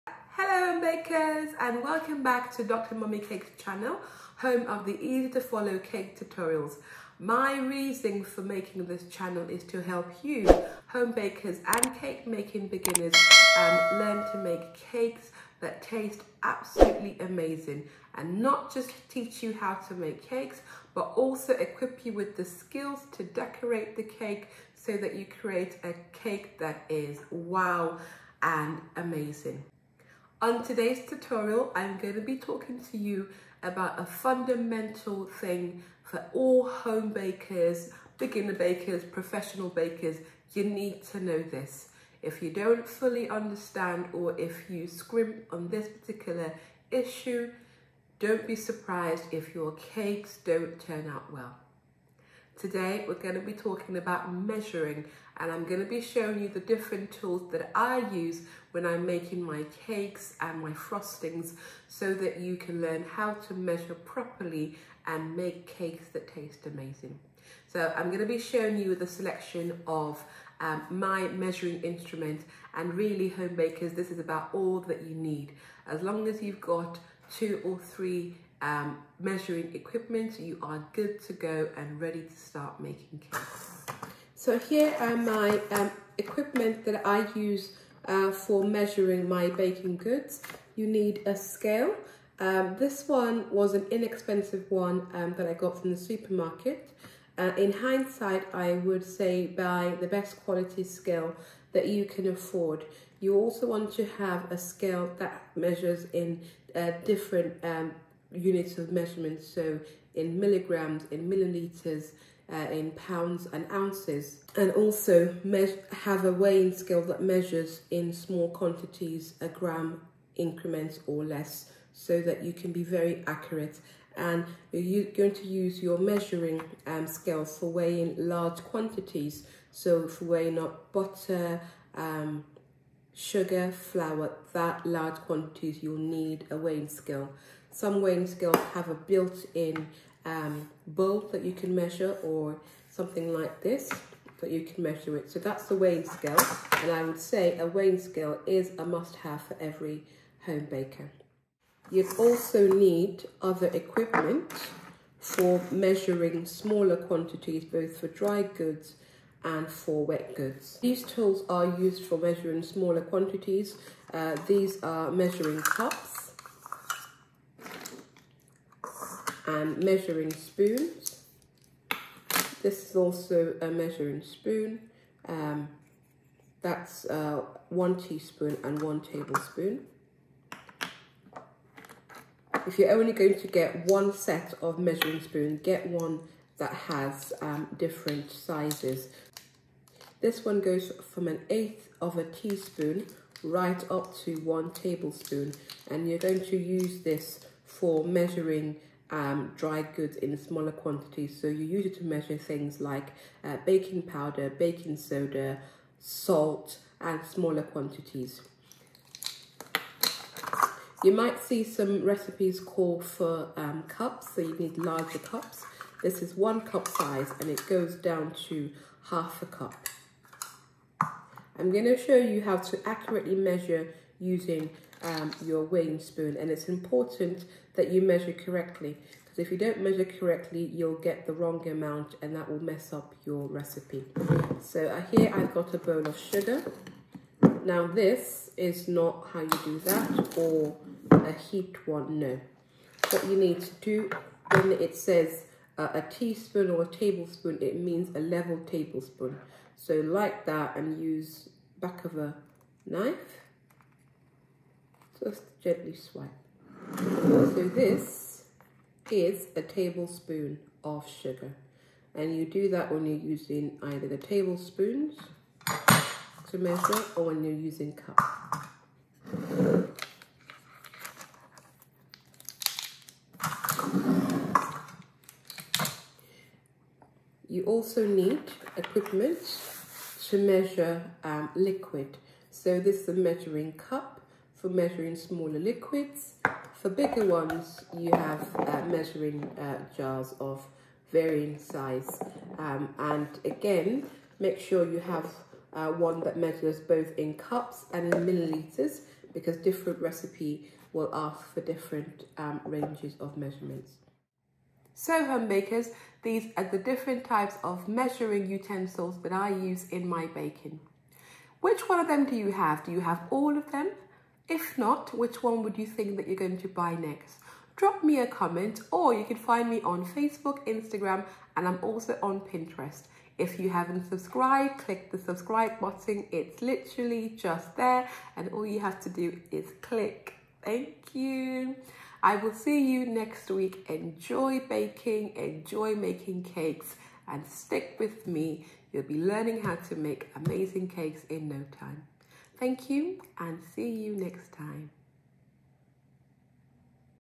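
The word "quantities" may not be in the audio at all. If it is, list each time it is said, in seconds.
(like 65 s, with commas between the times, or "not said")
118 s, 128 s, 135 s, 156 s, 163 s, 200 s, 207 s.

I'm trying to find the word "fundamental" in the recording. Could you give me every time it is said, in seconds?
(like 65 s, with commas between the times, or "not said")
34 s.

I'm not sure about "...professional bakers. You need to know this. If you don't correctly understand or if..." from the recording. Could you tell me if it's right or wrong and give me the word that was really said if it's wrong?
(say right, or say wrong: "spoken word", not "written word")
wrong: "fully", not "correctly".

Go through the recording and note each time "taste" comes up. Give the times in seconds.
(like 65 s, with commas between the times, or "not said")
15 s, 66 s.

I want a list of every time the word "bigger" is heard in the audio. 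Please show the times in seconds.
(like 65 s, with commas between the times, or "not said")
286 s.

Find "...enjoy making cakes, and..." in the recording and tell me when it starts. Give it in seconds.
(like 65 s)
335 s.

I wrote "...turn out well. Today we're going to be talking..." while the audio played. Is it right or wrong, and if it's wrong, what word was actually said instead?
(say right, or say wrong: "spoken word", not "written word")
right.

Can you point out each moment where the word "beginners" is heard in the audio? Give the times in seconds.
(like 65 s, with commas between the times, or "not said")
12 s, 38 s.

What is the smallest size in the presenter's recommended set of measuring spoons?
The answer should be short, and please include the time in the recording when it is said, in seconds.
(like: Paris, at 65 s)
an eighth of a teaspoon, at 191 s.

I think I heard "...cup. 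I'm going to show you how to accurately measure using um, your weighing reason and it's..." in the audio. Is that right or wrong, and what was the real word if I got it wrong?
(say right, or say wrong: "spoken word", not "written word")
wrong: "spoon", not "reason".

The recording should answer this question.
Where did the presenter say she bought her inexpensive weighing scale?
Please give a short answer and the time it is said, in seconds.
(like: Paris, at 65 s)
supermarket, at 95 s.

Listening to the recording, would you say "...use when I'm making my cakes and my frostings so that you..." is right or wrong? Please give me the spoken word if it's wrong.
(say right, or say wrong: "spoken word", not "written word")
right.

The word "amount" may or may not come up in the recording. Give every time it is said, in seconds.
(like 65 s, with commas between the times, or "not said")
231 s.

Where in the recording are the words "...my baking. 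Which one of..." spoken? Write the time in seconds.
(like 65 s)
310 s.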